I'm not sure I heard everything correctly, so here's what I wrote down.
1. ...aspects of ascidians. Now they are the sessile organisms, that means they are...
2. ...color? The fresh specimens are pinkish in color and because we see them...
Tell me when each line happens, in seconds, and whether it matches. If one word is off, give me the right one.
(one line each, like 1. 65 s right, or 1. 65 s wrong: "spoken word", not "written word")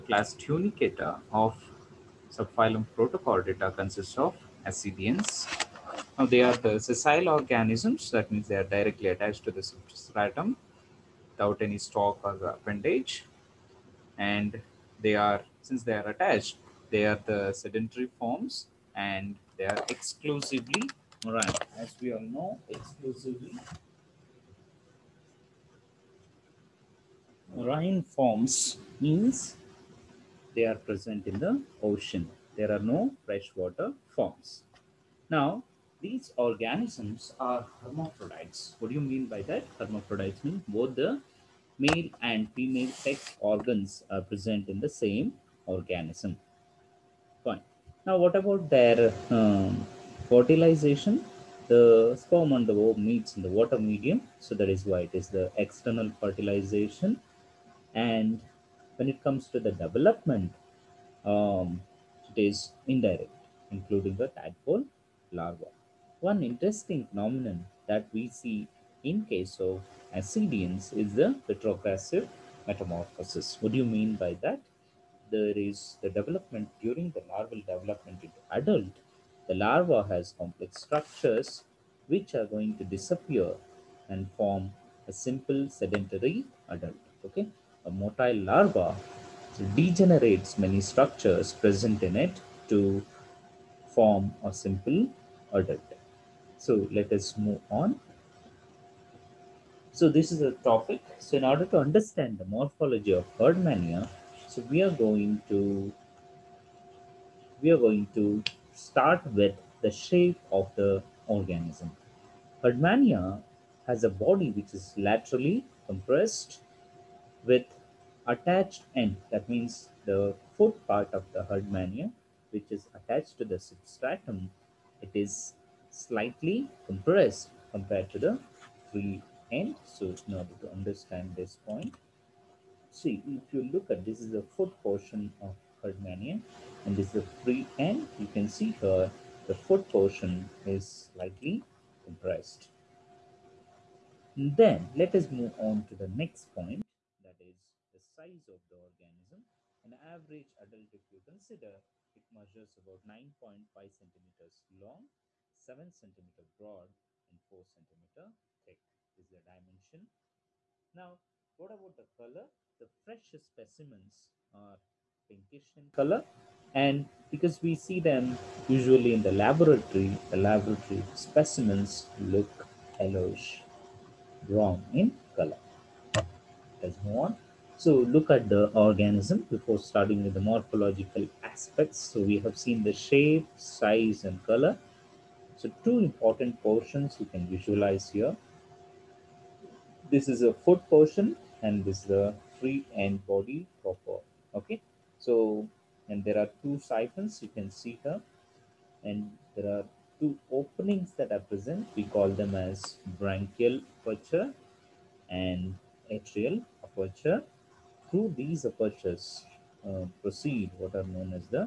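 1. 3 s wrong: "consists", not "aspects"
2. 162 s right.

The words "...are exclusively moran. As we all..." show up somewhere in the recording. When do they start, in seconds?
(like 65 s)
19 s.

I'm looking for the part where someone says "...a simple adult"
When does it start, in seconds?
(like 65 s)
94 s.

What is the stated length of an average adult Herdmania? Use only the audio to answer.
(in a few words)
9.5 centimeters.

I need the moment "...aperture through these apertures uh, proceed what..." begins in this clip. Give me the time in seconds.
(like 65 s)
206 s.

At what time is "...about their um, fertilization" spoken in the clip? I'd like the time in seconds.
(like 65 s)
48 s.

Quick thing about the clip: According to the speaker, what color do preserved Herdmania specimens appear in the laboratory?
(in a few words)
Yellowish brown.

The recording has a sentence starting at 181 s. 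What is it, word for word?
So we have seen the shape, size and color.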